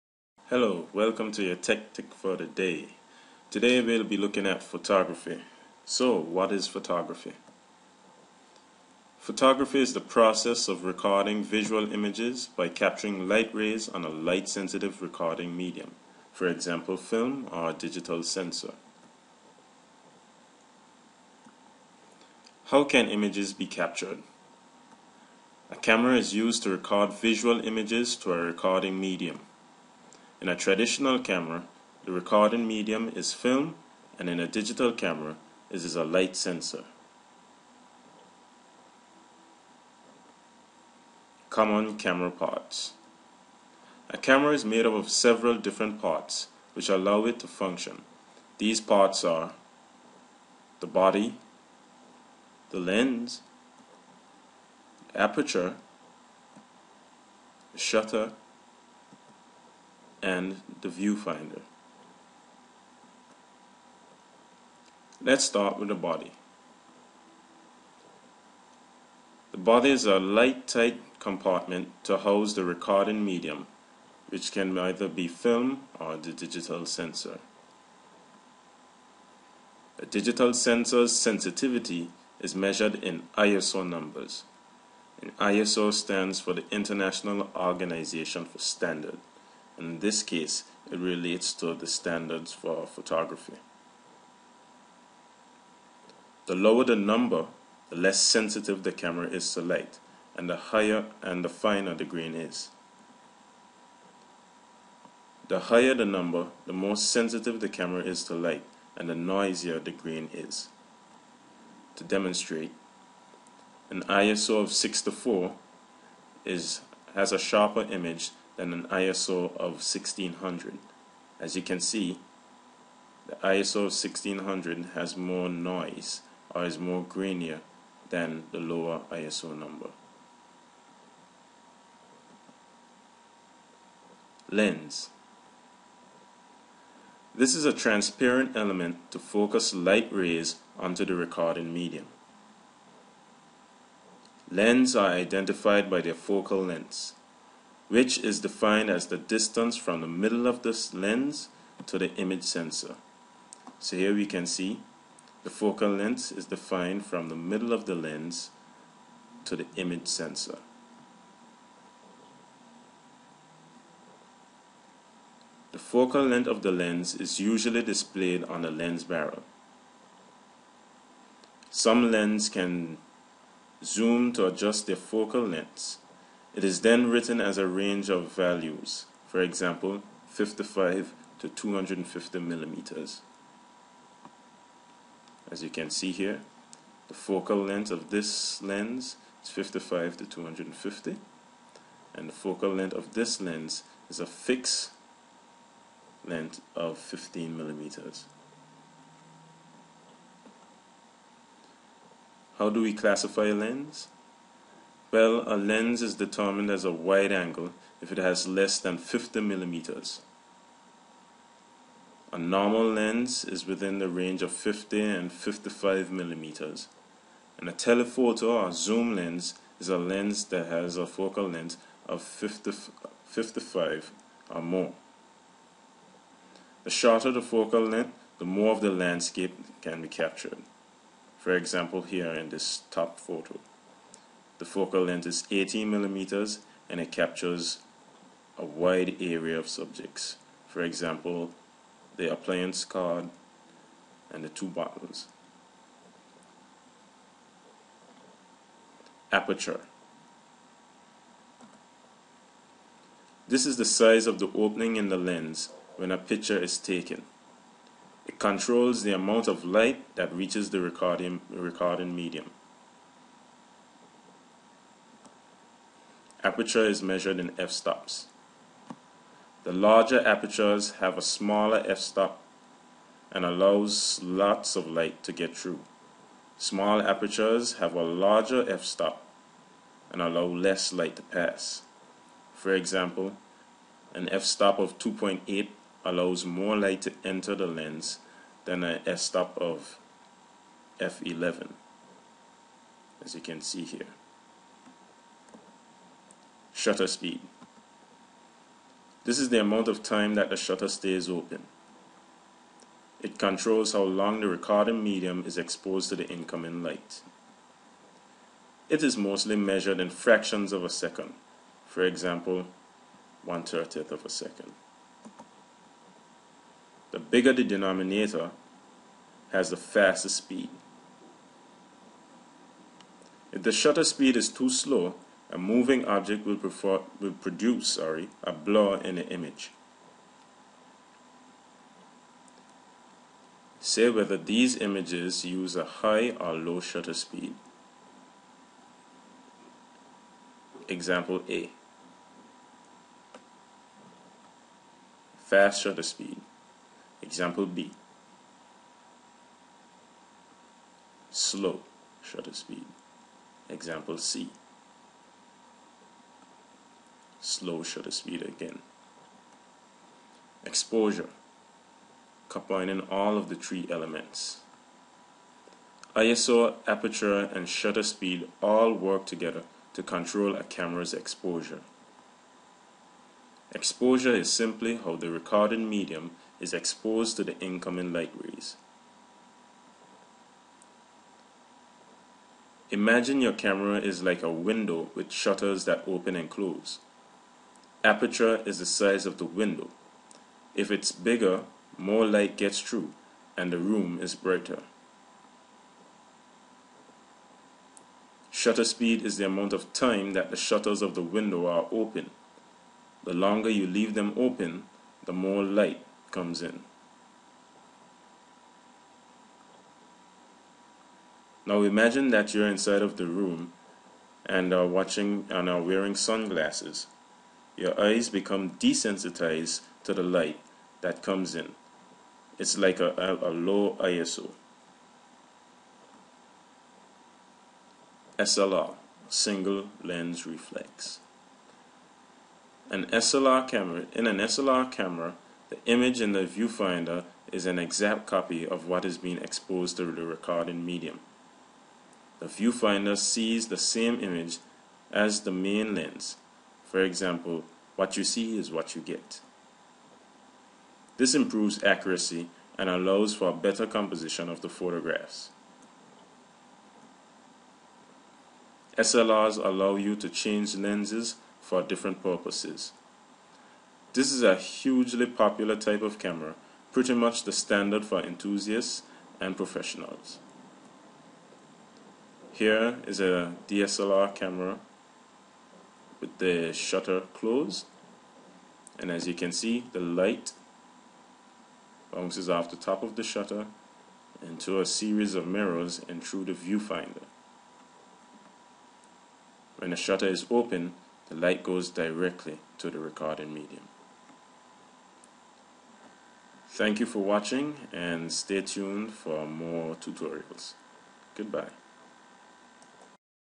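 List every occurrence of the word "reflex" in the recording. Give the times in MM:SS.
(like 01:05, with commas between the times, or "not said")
07:10.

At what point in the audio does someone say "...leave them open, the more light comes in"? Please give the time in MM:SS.
06:43.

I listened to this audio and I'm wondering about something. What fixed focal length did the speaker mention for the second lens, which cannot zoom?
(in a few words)
15 mm.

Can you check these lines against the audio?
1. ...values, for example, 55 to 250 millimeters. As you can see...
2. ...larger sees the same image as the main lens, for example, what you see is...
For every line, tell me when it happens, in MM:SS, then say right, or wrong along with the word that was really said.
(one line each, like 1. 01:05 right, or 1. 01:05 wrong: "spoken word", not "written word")
1. 02:58 right
2. 07:22 wrong: "viewfinder", not "larger".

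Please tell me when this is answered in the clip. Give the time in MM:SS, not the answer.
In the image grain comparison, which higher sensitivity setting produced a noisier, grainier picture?
02:03.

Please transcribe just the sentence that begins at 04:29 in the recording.
The larger apertures have a smaller f-stop and allows lots of light to get through.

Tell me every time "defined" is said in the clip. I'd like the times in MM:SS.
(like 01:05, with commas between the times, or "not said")
02:28, 02:36.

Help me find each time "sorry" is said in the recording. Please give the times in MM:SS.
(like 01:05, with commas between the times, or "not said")
05:27.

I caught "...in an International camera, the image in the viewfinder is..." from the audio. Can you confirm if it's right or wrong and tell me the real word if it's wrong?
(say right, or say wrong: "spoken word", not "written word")
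wrong: "SLR", not "International".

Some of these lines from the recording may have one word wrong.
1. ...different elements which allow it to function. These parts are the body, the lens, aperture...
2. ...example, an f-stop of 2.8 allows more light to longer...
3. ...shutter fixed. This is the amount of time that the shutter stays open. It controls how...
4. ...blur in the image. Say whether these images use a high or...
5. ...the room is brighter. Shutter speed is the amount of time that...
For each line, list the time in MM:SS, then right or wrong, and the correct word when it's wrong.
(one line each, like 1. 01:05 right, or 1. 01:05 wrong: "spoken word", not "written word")
1. 00:45 wrong: "parts", not "elements"
2. 04:42 wrong: "enter", not "longer"
3. 04:56 wrong: "speed", not "fixed"
4. 05:28 right
5. 06:33 right.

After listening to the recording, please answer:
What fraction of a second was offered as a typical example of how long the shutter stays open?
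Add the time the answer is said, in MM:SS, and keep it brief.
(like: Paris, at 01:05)
1/30 second, at 05:13.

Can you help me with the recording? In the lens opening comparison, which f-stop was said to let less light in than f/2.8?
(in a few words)
f/11.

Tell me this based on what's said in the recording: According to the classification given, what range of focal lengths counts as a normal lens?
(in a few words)
50 to 55 mm.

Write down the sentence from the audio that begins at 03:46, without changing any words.
The shorter the focal length, the more of the landscape can be captured.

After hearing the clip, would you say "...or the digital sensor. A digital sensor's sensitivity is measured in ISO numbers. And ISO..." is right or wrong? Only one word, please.
right.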